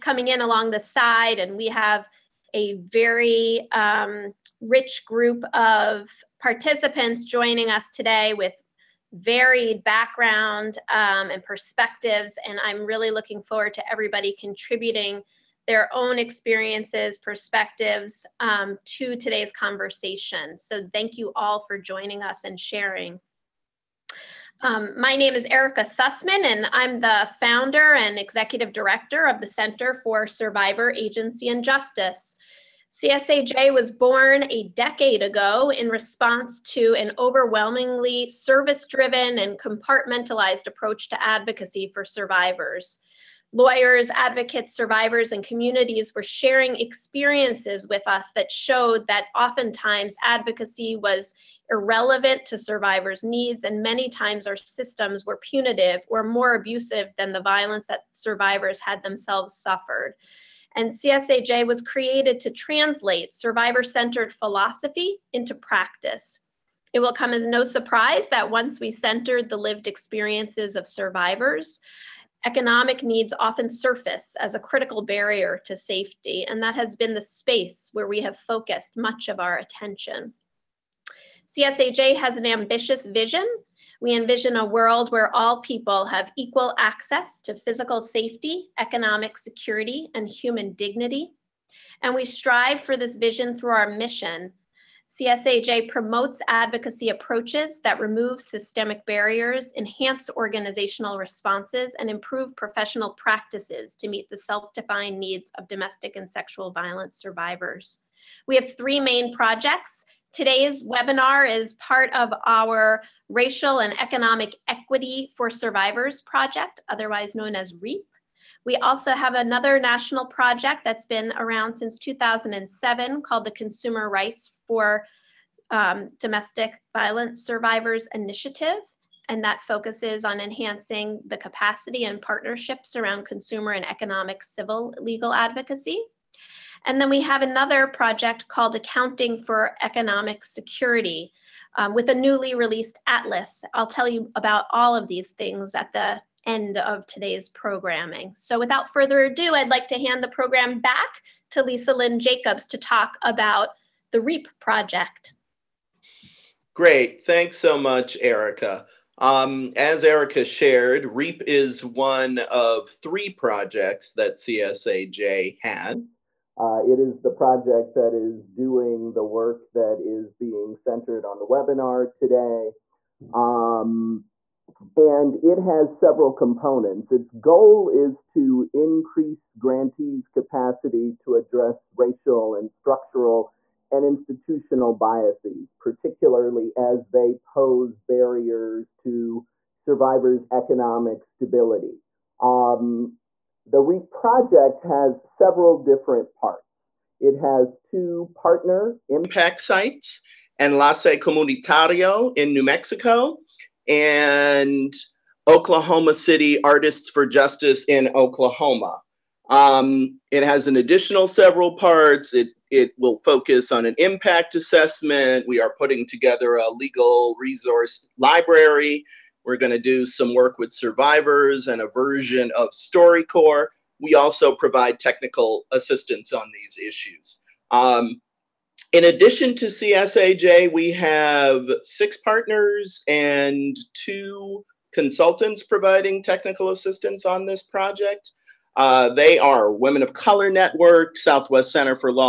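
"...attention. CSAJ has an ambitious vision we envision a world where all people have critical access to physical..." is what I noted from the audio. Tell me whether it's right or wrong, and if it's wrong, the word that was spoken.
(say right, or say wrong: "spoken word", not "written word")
wrong: "equal", not "critical".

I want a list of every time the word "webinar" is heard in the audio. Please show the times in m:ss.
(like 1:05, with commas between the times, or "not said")
1:50, 2:51.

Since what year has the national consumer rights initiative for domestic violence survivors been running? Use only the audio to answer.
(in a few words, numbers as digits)
2007.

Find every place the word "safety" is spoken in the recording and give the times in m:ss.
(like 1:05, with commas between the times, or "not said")
1:15, 1:28.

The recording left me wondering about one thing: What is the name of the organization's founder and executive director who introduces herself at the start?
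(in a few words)
Erika Sussman.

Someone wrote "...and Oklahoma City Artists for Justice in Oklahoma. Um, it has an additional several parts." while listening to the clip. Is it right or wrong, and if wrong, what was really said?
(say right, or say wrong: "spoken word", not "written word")
right.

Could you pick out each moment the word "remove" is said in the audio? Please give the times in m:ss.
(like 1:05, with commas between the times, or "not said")
1:37.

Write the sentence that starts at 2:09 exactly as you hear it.
And that focuses on enhancing the capacity and partnerships around consumer and economic civil legal advocacy.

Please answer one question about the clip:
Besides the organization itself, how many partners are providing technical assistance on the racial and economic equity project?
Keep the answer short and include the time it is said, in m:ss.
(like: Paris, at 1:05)
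6, at 3:51.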